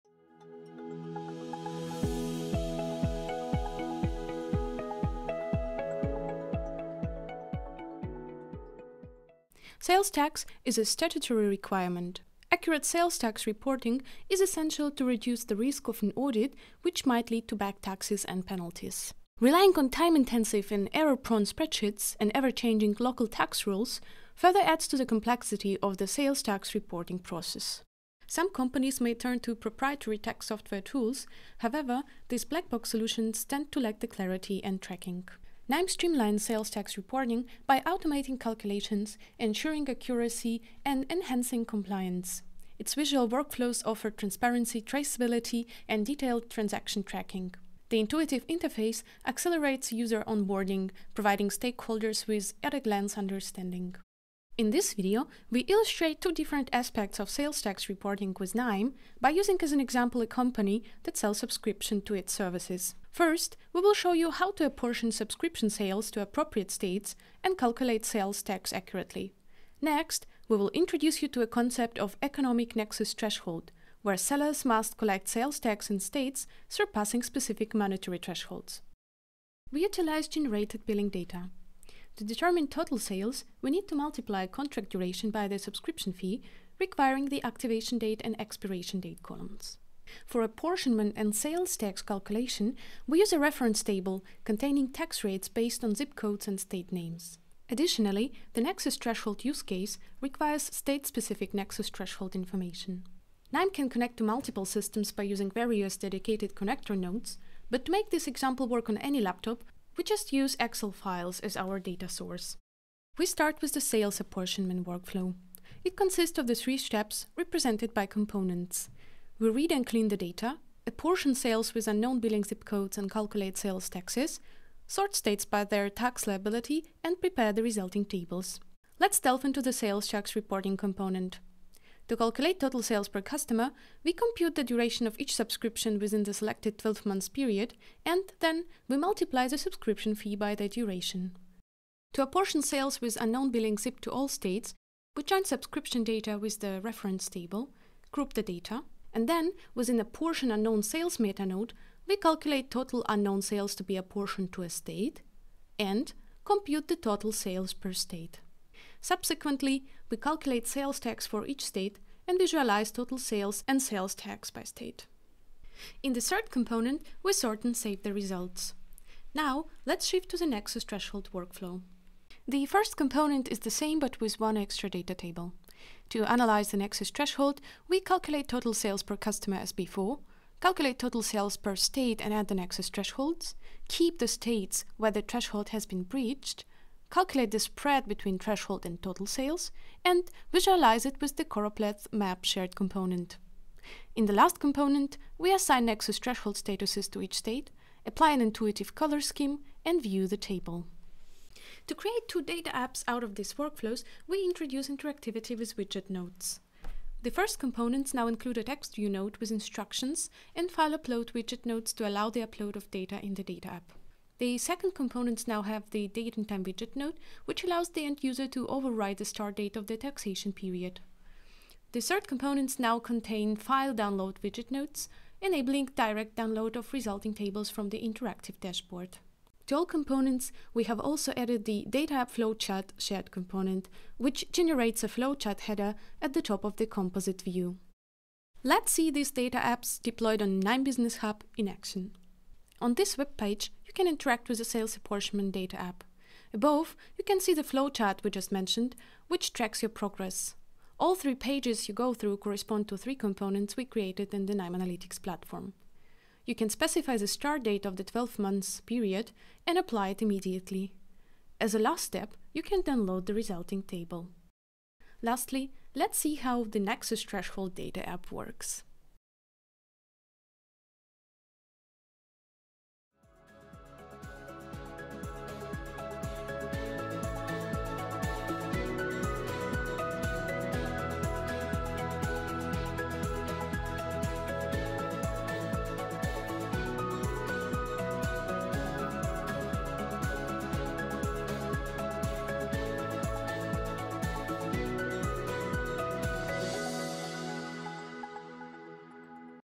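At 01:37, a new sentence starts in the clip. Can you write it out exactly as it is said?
Additionally, the nexus threshold use case requires state-specific nexus threshold information.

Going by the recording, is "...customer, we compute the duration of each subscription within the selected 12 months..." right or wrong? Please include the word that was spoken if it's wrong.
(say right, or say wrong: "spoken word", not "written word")
right.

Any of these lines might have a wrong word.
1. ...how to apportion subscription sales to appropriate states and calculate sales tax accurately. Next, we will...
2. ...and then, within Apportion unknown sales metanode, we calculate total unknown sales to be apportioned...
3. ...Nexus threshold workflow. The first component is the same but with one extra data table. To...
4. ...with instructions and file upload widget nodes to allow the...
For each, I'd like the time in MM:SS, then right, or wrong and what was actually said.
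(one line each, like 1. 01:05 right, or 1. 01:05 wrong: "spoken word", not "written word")
1. 01:04 right
2. 02:29 right
3. 02:50 right
4. 03:29 right.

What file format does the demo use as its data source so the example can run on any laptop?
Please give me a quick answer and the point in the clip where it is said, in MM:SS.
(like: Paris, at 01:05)
Excel, at 01:50.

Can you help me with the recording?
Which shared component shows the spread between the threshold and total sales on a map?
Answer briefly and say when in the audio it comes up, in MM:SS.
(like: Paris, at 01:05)
choropleth map, at 03:11.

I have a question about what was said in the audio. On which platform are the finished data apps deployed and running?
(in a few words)
KNIME Business Hub.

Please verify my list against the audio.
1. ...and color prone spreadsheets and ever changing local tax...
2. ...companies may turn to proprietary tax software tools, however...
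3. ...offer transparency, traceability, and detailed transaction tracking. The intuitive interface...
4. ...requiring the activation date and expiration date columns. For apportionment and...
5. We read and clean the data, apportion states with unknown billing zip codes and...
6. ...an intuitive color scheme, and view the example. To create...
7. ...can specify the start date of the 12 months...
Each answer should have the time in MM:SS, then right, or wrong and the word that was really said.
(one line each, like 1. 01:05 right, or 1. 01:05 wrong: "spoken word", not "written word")
1. 00:20 wrong: "error", not "color"
2. 00:28 right
3. 00:43 right
4. 01:26 right
5. 01:59 wrong: "sales", not "states"
6. 03:18 wrong: "table", not "example"
7. 04:16 right.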